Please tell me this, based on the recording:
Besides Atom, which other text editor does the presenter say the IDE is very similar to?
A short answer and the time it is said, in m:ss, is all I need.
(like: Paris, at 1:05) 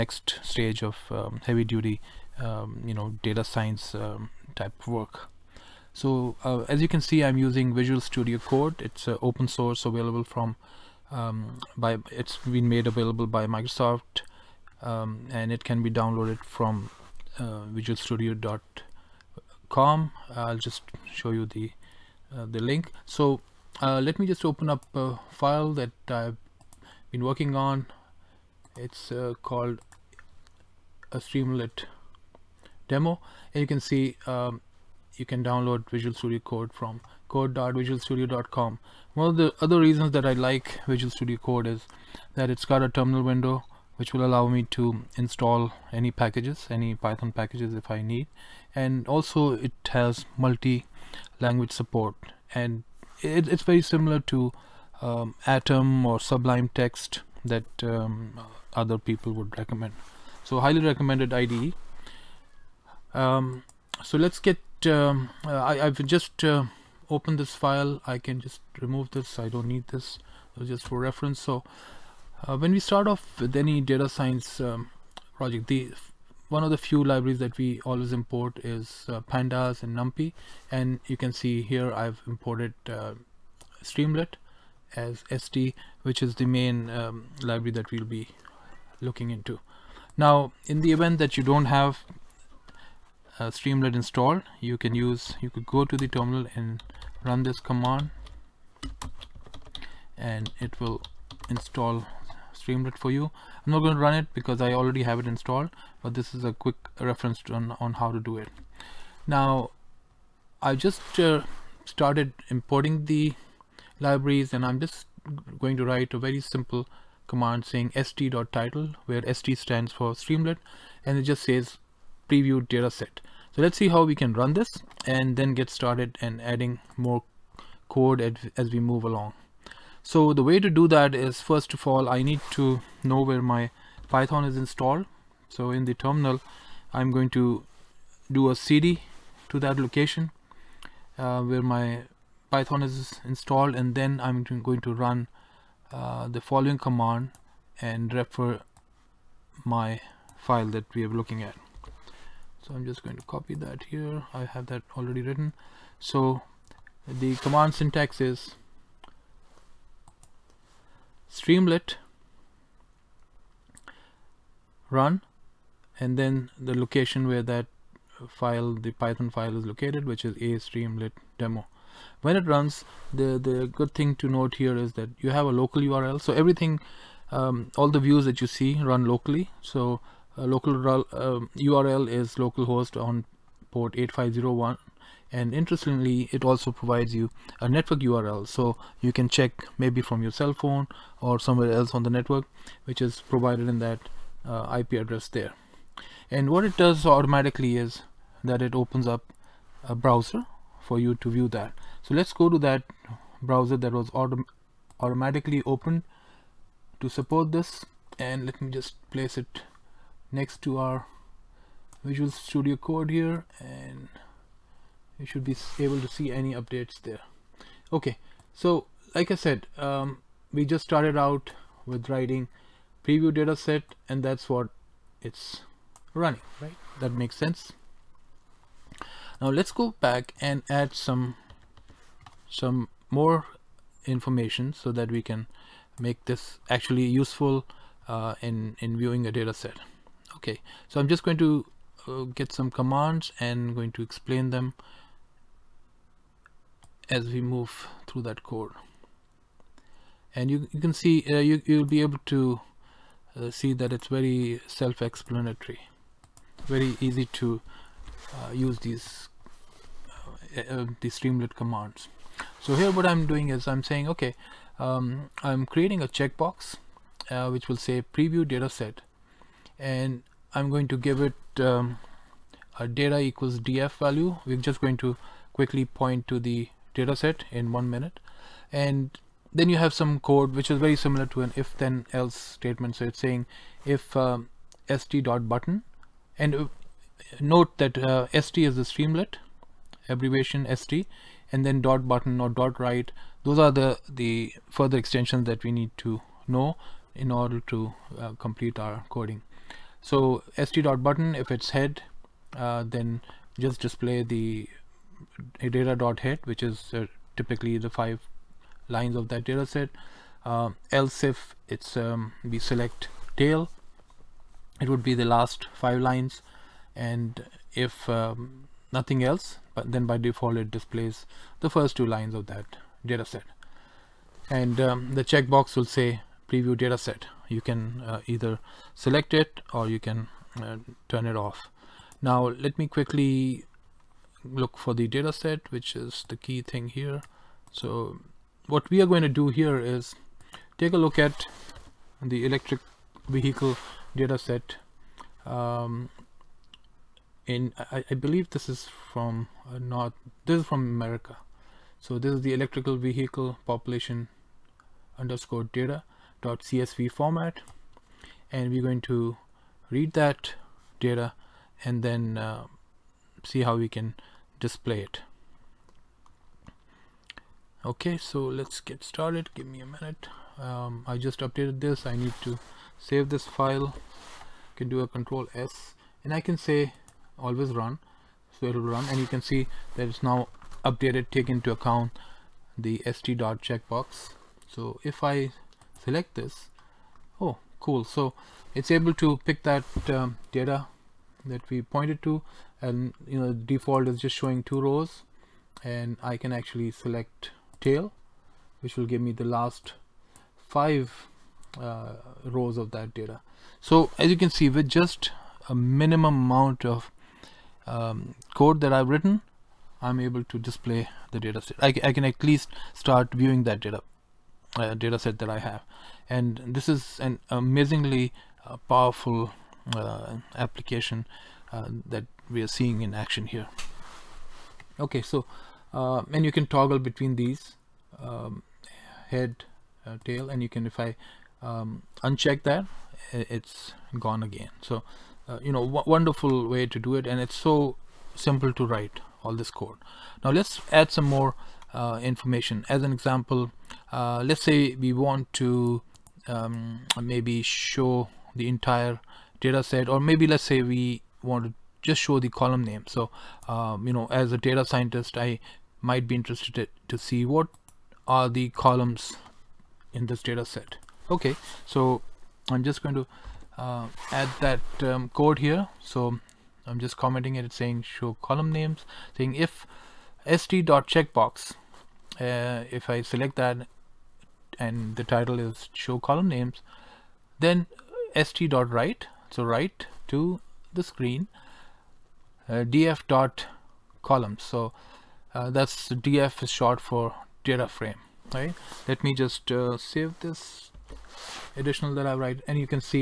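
Sublime Text, at 0:56.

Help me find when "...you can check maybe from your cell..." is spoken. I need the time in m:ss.
3:08.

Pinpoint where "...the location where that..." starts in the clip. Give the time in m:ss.
2:46.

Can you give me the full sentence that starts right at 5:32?
Now let me quickly look for the data set, which is the key thing here.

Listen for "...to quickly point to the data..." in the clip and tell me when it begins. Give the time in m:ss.
4:34.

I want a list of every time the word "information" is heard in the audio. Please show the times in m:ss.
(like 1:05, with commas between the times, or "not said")
3:54, 7:22.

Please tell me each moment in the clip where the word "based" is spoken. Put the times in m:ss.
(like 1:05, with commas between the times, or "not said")
not said.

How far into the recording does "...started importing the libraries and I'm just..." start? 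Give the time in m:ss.
1:51.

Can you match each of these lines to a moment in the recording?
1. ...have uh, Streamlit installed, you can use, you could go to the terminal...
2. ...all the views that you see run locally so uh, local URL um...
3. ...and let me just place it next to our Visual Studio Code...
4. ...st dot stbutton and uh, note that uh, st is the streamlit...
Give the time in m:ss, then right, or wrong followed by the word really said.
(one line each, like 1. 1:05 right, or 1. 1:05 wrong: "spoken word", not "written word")
1. 1:31 right
2. 2:57 right
3. 3:28 right
4. 4:44 wrong: "button", not "stbutton".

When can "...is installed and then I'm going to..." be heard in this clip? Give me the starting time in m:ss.
2:22.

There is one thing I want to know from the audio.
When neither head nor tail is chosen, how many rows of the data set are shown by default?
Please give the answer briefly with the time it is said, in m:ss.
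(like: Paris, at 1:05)
2, at 5:21.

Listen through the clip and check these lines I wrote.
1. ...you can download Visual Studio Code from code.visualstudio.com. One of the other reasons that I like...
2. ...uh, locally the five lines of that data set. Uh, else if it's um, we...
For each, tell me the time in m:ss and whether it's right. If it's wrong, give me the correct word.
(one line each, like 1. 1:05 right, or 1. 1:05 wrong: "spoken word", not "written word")
1. 0:35 right
2. 5:06 wrong: "typically", not "locally".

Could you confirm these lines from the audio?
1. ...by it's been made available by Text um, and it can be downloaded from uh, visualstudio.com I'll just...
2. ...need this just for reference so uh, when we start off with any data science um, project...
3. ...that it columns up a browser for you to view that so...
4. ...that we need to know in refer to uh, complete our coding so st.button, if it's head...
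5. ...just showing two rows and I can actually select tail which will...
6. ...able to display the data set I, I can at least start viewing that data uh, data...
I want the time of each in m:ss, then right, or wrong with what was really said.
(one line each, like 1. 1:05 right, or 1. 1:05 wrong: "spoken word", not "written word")
1. 0:11 wrong: "Microsoft", not "Text"
2. 1:09 right
3. 3:18 wrong: "opens", not "columns"
4. 4:55 wrong: "order", not "refer"
5. 6:34 right
6. 6:50 right.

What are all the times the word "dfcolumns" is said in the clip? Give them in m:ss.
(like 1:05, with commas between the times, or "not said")
8:02.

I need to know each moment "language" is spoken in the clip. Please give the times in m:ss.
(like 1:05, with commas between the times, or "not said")
0:50.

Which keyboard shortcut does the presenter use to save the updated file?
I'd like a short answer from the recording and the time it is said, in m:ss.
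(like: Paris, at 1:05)
Control S, at 6:15.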